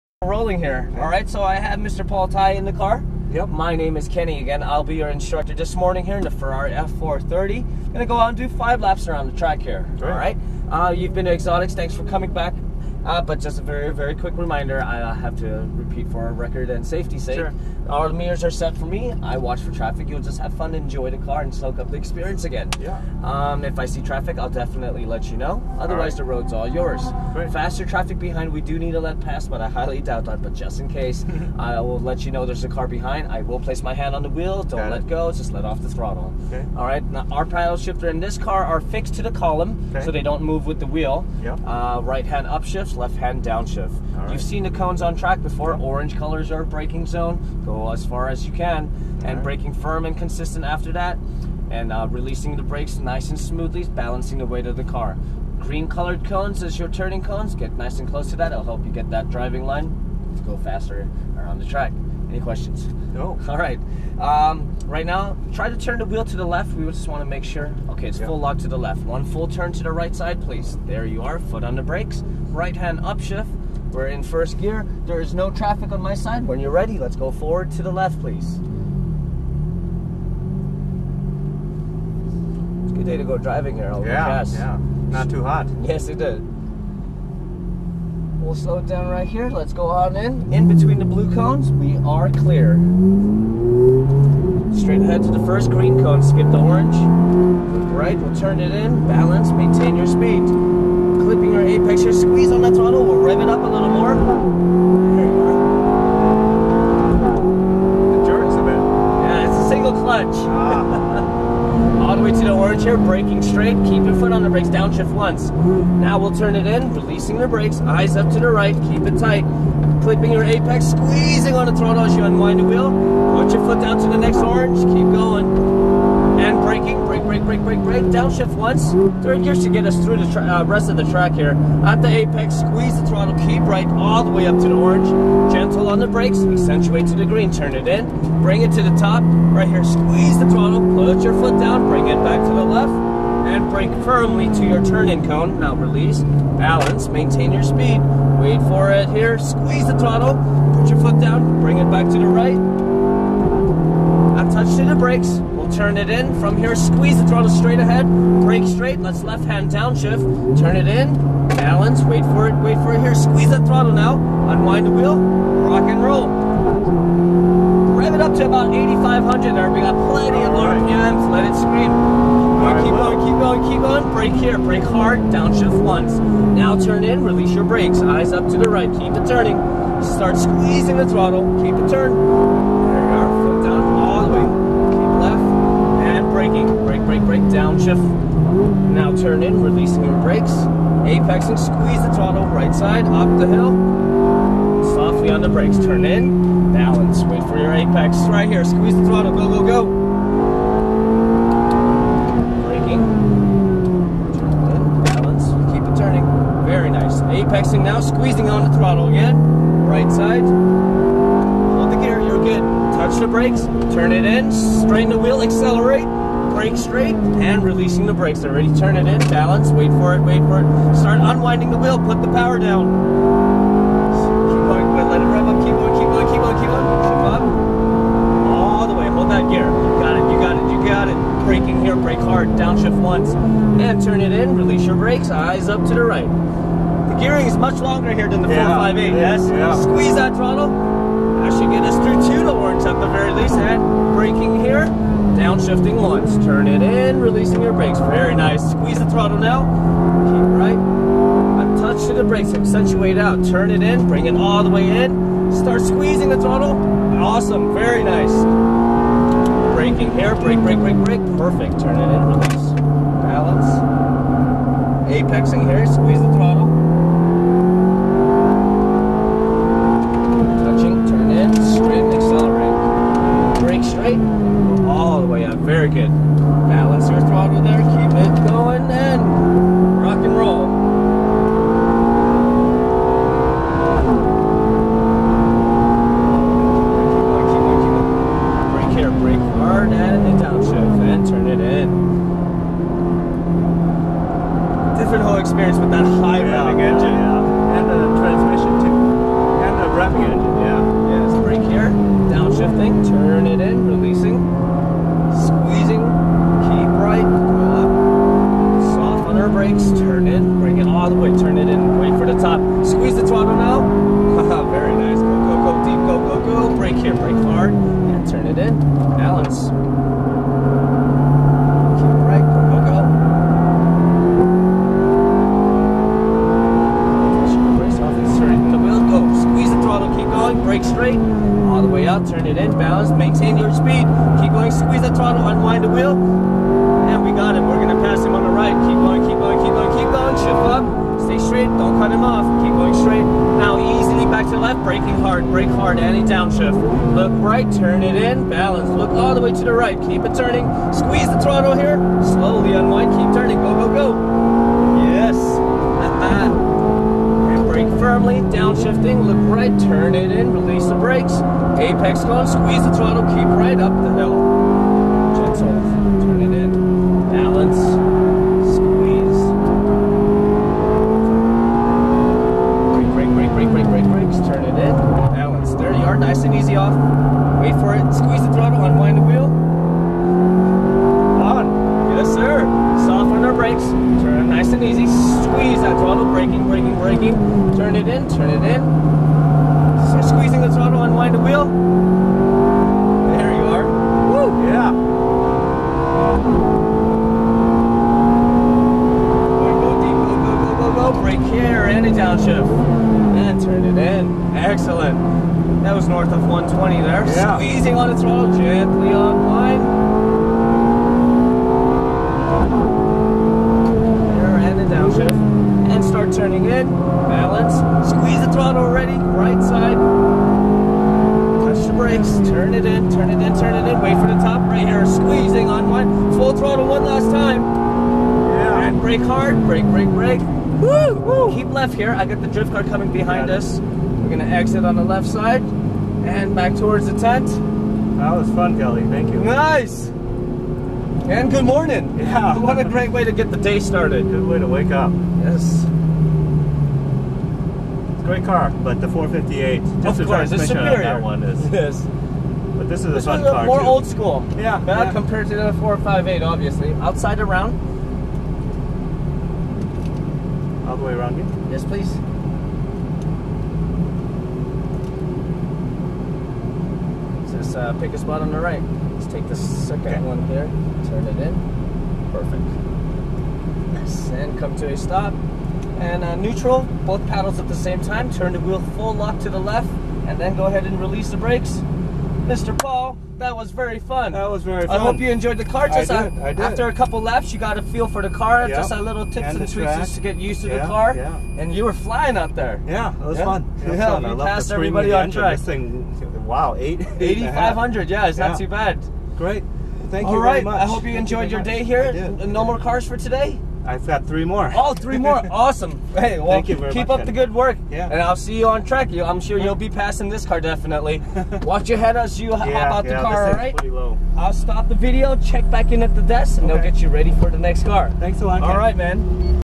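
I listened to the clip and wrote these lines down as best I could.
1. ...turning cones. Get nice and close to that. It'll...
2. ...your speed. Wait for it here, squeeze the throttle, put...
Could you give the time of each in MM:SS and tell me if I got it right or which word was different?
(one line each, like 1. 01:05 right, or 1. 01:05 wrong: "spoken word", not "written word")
1. 00:56 right
2. 02:27 right.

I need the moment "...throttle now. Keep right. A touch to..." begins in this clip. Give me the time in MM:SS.
04:09.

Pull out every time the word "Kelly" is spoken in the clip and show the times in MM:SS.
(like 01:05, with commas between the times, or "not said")
07:18.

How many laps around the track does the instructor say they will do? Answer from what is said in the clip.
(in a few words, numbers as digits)
5.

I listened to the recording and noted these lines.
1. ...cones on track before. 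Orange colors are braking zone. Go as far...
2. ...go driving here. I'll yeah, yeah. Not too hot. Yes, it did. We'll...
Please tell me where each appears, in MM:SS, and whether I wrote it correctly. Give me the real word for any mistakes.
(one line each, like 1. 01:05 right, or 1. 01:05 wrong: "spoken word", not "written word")
1. 00:44 right
2. 01:23 right.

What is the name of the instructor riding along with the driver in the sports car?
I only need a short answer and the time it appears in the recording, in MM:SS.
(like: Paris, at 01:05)
Kenny, at 00:04.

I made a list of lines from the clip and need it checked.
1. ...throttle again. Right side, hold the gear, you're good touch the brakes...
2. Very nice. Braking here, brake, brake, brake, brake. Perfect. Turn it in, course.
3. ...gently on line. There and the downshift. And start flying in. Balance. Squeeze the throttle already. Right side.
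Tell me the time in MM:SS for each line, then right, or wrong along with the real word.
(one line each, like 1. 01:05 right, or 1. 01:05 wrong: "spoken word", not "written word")
1. 03:28 right
2. 04:17 wrong: "release", not "course"
3. 06:48 wrong: "turning", not "flying".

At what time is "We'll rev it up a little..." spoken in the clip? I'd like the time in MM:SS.
01:43.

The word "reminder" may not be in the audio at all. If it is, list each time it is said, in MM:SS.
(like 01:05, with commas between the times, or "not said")
00:14.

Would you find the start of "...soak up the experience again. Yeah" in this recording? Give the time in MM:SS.
00:21.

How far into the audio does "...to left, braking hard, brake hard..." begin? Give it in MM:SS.
05:44.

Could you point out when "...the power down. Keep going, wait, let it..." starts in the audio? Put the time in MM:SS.
03:42.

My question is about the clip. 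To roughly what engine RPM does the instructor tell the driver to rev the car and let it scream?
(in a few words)
8,500.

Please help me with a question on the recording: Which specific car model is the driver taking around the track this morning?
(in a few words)
Ferrari F430.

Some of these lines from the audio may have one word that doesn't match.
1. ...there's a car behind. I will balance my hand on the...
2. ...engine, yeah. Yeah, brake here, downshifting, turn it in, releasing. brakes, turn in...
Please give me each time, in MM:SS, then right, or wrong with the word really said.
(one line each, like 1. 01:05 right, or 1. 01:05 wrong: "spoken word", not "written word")
1. 00:32 wrong: "place", not "balance"
2. 05:00 right.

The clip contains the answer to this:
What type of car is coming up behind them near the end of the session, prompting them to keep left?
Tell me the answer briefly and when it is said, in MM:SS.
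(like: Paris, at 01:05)
Drift car, at 07:12.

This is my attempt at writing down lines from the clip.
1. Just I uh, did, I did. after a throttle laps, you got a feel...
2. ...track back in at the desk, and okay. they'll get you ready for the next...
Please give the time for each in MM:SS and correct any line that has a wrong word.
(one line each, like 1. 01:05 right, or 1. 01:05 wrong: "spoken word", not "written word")
1. 08:05 wrong: "couple", not "throttle"
2. 08:35 wrong: "check", not "track".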